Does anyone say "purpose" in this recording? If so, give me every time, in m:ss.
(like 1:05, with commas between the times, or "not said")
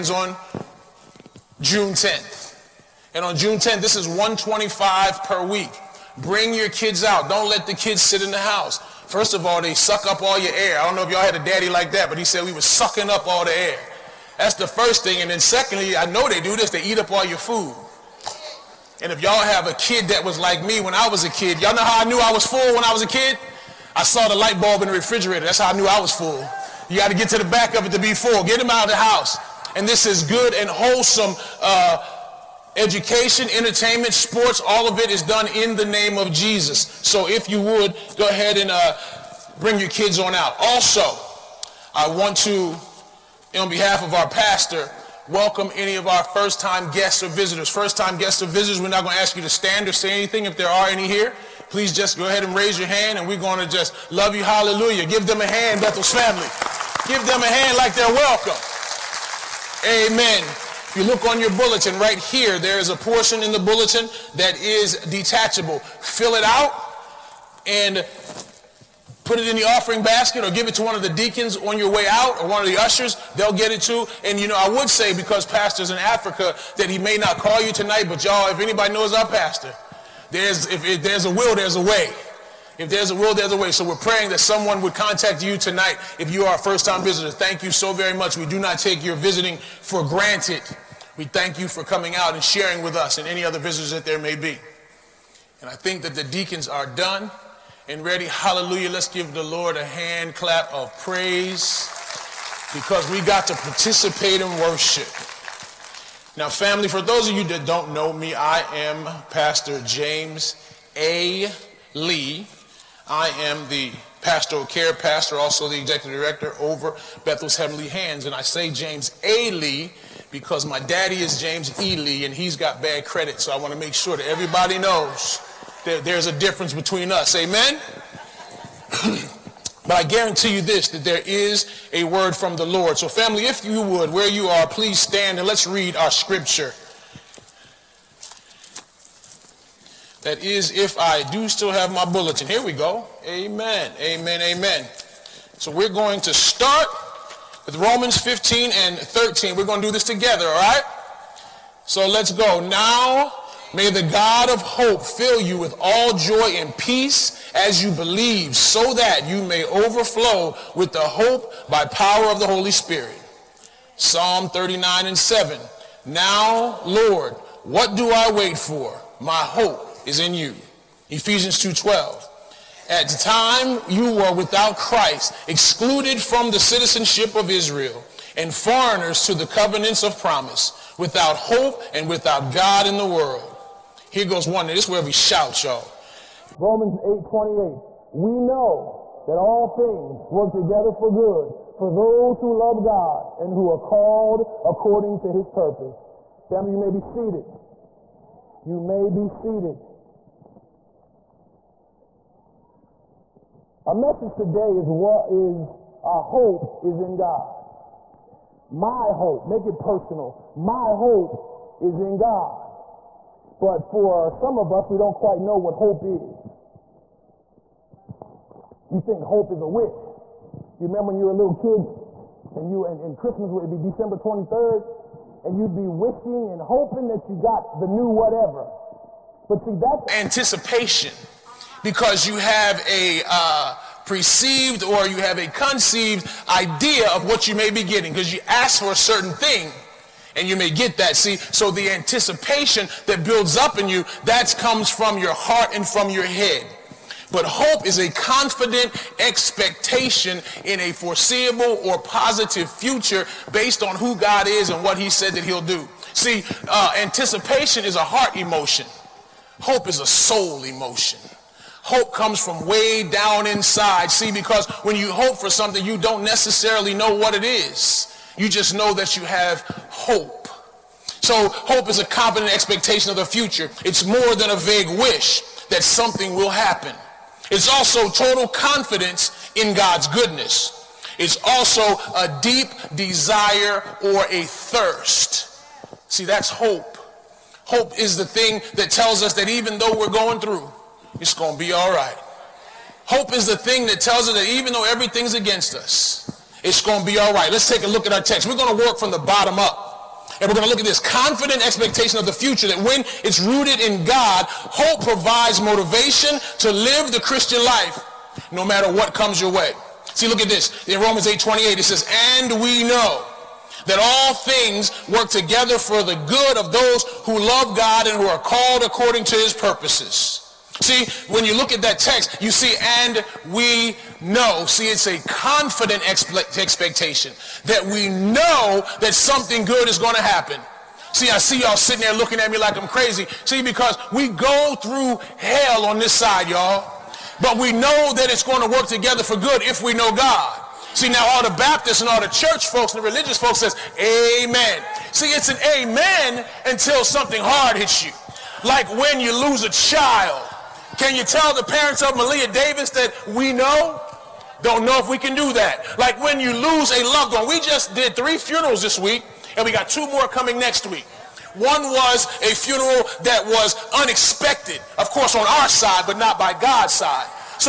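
3:15, 5:19.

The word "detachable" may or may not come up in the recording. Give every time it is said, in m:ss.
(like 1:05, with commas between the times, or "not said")
1:04.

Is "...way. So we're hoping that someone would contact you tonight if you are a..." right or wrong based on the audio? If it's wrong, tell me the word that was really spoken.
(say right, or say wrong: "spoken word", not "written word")
wrong: "praying", not "hoping".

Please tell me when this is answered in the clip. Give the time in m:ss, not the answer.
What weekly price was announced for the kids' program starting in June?
0:04.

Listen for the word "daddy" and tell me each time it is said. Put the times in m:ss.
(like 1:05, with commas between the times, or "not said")
0:11, 2:00.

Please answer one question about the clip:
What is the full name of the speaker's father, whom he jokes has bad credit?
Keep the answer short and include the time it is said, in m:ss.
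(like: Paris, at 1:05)
James E. Lee, at 2:01.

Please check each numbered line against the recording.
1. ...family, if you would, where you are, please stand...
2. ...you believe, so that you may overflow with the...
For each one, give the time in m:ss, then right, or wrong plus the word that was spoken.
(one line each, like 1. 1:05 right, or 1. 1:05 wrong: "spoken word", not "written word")
1. 2:13 right
2. 2:37 right.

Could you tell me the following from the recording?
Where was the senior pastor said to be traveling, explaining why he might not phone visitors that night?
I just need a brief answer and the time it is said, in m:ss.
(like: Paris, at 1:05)
Africa, at 1:15.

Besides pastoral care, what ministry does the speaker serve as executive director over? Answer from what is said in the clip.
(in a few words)
Bethel's Heavenly Hands.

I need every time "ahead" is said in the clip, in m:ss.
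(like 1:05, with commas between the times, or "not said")
0:38, 0:52.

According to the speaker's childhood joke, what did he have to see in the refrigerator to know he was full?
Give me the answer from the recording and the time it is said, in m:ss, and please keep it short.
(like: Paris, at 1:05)
the light bulb, at 0:24.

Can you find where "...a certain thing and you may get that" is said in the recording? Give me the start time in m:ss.
3:58.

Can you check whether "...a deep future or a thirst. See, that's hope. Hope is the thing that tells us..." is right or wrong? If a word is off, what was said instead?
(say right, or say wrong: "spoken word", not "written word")
wrong: "desire", not "future".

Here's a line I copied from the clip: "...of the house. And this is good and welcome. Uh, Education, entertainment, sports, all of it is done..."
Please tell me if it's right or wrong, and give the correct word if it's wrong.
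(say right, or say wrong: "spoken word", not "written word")
wrong: "wholesome", not "welcome".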